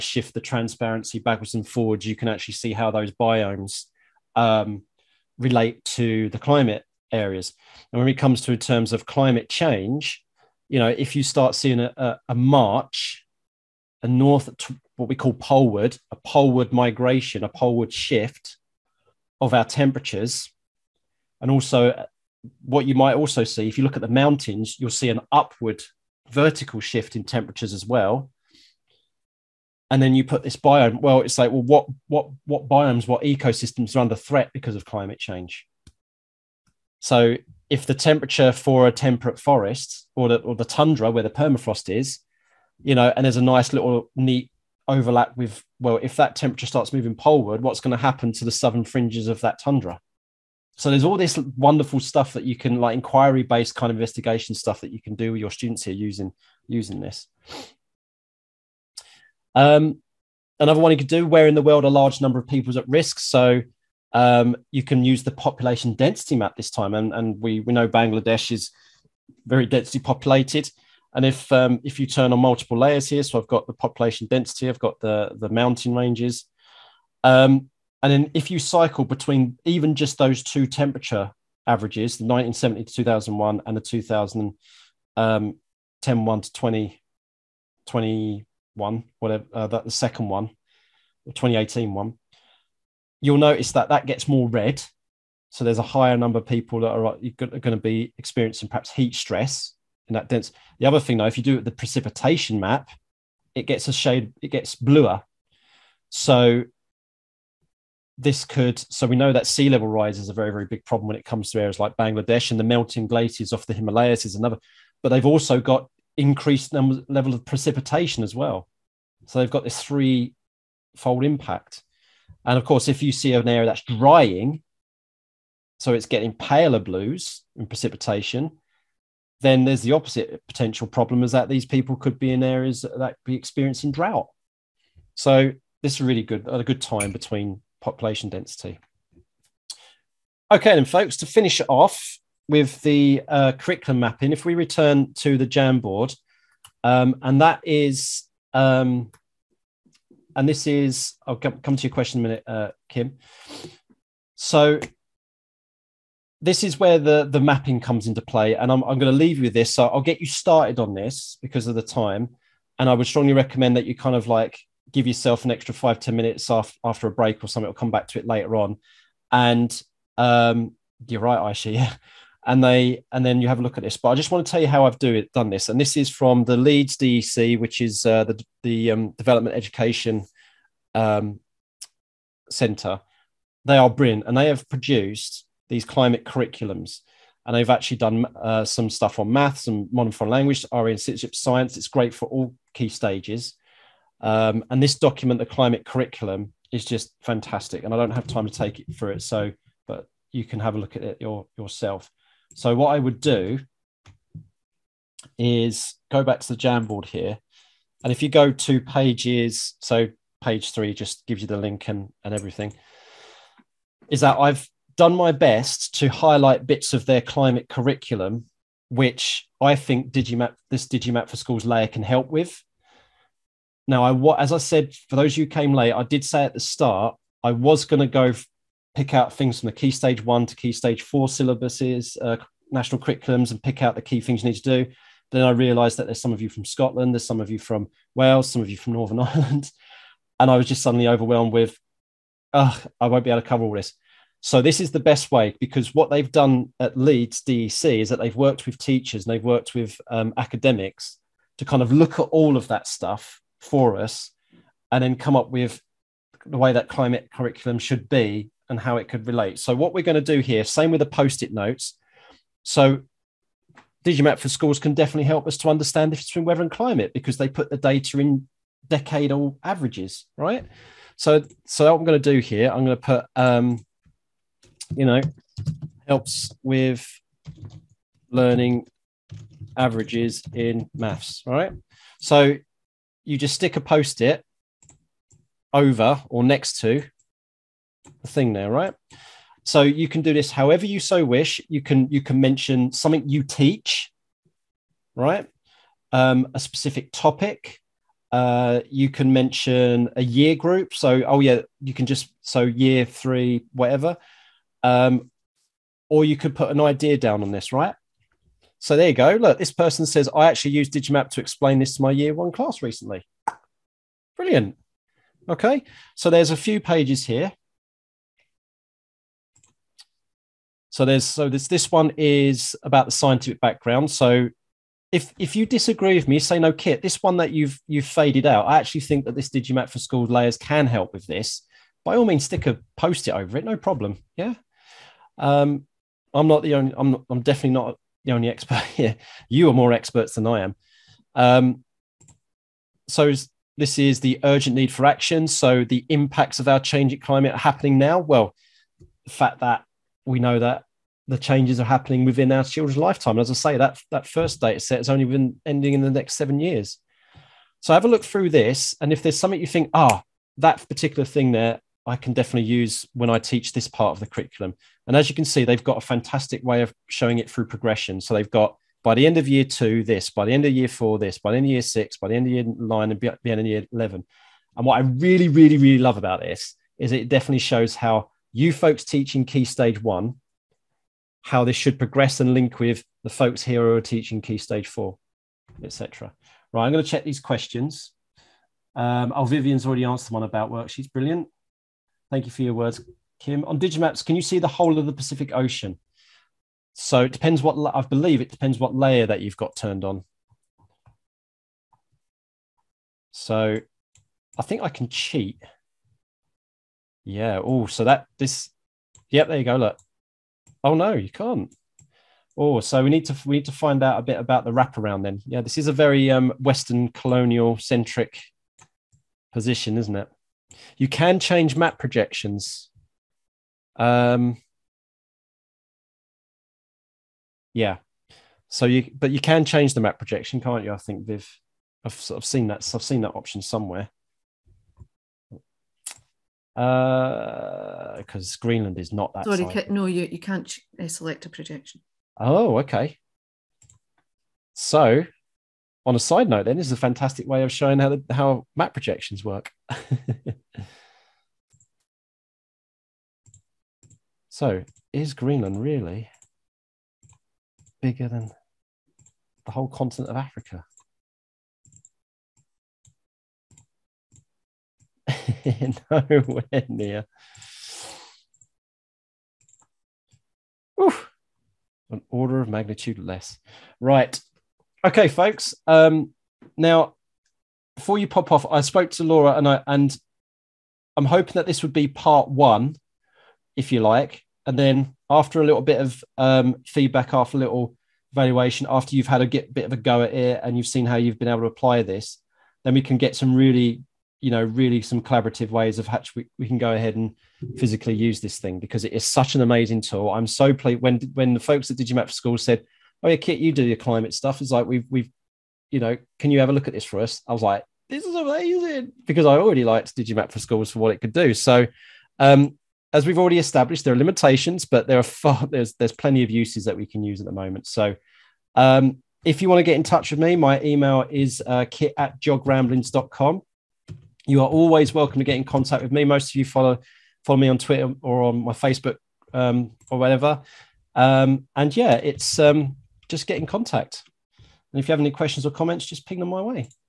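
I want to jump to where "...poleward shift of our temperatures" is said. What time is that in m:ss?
0:17.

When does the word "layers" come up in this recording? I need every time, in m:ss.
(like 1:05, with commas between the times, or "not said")
1:12, 3:41, 5:30, 6:38.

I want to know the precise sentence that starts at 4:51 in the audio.
You can you can mention something you teach, right?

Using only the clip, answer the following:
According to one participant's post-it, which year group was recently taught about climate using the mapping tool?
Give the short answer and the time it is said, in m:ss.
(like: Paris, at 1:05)
Year one, at 5:12.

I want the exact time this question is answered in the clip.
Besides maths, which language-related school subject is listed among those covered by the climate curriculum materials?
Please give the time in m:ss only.
3:09.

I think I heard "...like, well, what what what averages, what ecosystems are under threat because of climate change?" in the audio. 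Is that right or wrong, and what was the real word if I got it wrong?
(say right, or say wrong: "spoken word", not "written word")
wrong: "biomes", not "averages".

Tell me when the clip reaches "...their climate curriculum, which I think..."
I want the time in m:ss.
3:37.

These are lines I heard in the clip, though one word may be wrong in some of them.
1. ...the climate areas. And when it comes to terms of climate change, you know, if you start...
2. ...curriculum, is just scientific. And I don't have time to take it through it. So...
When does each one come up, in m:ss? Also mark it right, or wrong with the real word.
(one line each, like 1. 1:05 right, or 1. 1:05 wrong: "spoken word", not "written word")
1. 0:06 right
2. 3:15 wrong: "fantastic", not "scientific".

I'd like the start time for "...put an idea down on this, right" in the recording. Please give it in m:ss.
5:06.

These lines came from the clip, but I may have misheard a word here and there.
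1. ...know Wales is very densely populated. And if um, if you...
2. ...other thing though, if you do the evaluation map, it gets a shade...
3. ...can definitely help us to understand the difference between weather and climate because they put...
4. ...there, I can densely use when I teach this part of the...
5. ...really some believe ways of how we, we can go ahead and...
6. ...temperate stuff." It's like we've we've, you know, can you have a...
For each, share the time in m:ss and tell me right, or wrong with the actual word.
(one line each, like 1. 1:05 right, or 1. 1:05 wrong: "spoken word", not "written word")
1. 1:07 wrong: "Bangladesh", not "Wales"
2. 1:40 wrong: "precipitation", not "evaluation"
3. 4:24 right
4. 6:01 wrong: "definitely", not "densely"
5. 8:14 wrong: "collaborative", not "believe"
6. 8:23 wrong: "climate", not "temperate".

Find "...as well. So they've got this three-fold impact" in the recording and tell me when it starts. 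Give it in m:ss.
1:58.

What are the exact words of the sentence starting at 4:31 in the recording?
So, so what I'm going to do here, I'm going to put um, you know, helps with learning averages in maths, right?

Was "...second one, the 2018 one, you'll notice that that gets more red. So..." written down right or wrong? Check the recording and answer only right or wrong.
right.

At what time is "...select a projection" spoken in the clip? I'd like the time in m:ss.
7:21.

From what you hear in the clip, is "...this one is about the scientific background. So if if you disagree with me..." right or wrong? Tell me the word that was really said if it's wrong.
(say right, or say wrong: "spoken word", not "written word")
right.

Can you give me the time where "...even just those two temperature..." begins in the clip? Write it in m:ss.
1:19.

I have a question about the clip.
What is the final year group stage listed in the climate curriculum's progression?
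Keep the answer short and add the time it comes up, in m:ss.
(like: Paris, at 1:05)
Year 11, at 6:13.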